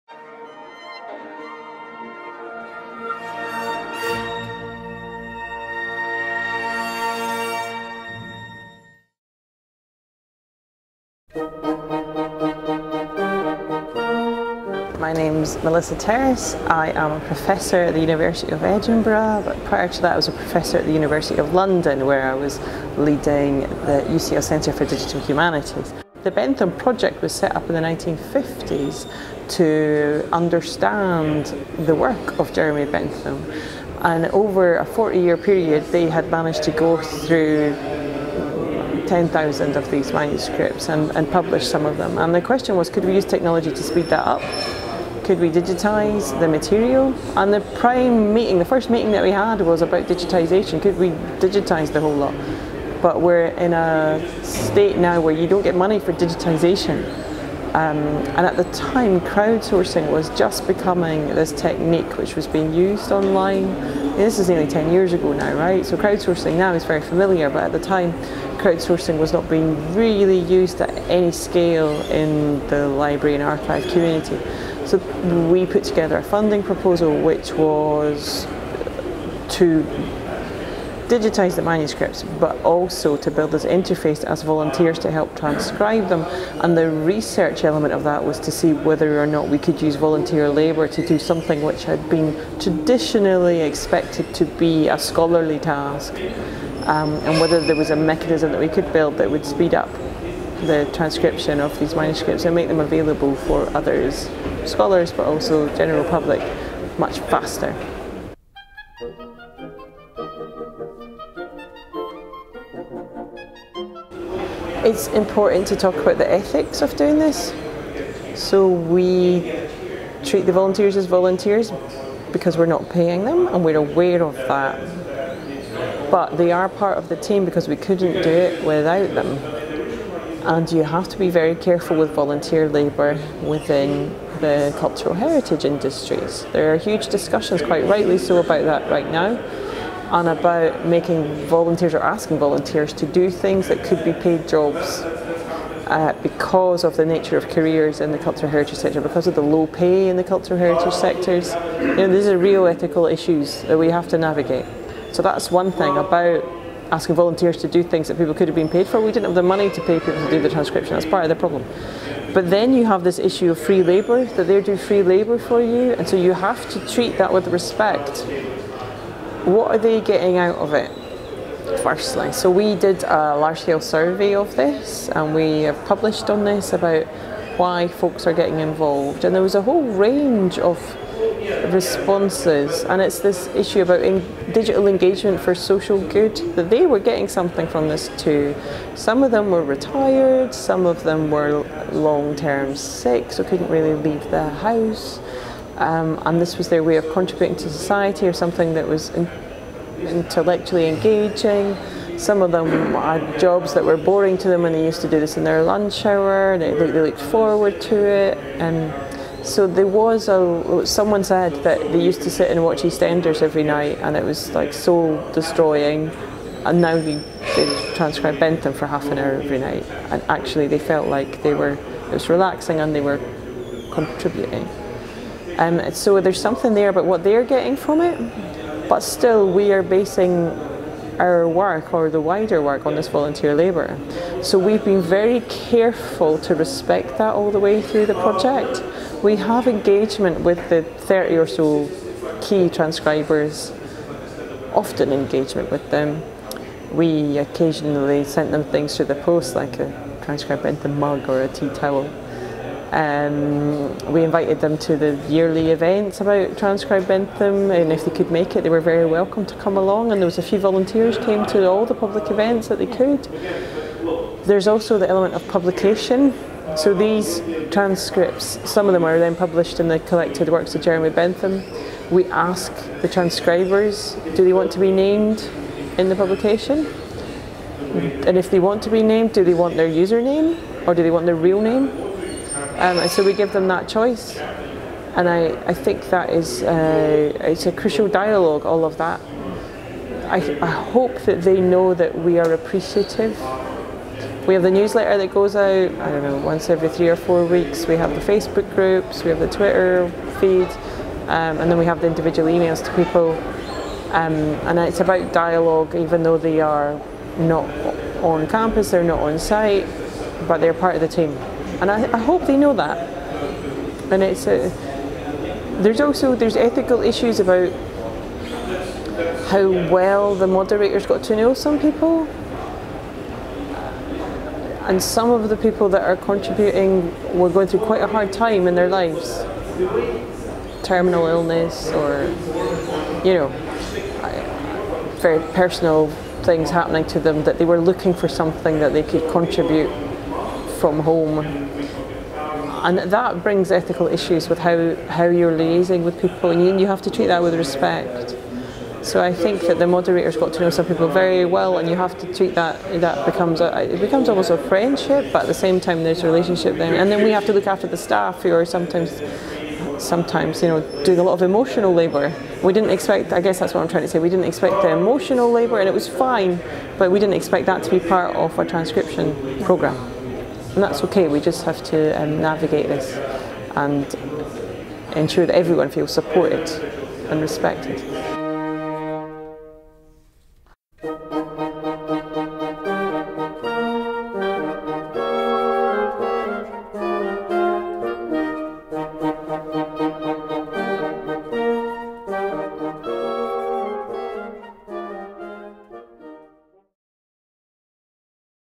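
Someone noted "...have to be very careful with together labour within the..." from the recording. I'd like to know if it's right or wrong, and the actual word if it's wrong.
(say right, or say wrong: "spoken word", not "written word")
wrong: "volunteer", not "together".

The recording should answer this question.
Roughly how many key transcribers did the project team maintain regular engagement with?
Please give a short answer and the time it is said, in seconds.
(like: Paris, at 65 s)
30, at 240 s.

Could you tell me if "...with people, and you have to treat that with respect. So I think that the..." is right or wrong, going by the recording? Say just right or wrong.
right.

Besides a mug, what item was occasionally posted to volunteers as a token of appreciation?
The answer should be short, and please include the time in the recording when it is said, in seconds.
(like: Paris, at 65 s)
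a tea towel, at 251 s.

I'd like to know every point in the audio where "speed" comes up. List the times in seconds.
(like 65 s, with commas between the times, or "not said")
43 s, 99 s.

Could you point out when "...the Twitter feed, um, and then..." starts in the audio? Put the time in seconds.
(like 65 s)
299 s.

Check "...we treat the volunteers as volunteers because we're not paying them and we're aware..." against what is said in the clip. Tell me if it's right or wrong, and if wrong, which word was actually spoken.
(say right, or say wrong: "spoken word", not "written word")
right.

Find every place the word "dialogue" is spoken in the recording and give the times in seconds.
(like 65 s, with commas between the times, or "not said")
288 s, 305 s.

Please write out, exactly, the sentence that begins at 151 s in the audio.
You know, these are real ethical issues that we have to navigate.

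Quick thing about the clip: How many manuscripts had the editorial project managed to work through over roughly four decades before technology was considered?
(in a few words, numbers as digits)
10,000.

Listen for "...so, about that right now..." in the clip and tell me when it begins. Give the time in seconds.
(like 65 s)
138 s.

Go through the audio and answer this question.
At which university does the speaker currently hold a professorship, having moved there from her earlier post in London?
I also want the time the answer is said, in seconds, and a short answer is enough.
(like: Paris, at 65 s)
University of Edinburgh, at 17 s.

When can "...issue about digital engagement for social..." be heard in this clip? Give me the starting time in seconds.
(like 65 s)
183 s.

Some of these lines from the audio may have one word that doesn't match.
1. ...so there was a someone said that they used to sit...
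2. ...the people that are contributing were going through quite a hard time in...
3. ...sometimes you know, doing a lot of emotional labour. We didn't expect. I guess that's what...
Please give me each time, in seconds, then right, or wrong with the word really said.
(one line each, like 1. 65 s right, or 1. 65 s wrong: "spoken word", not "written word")
1. 209 s right
2. 325 s right
3. 359 s right.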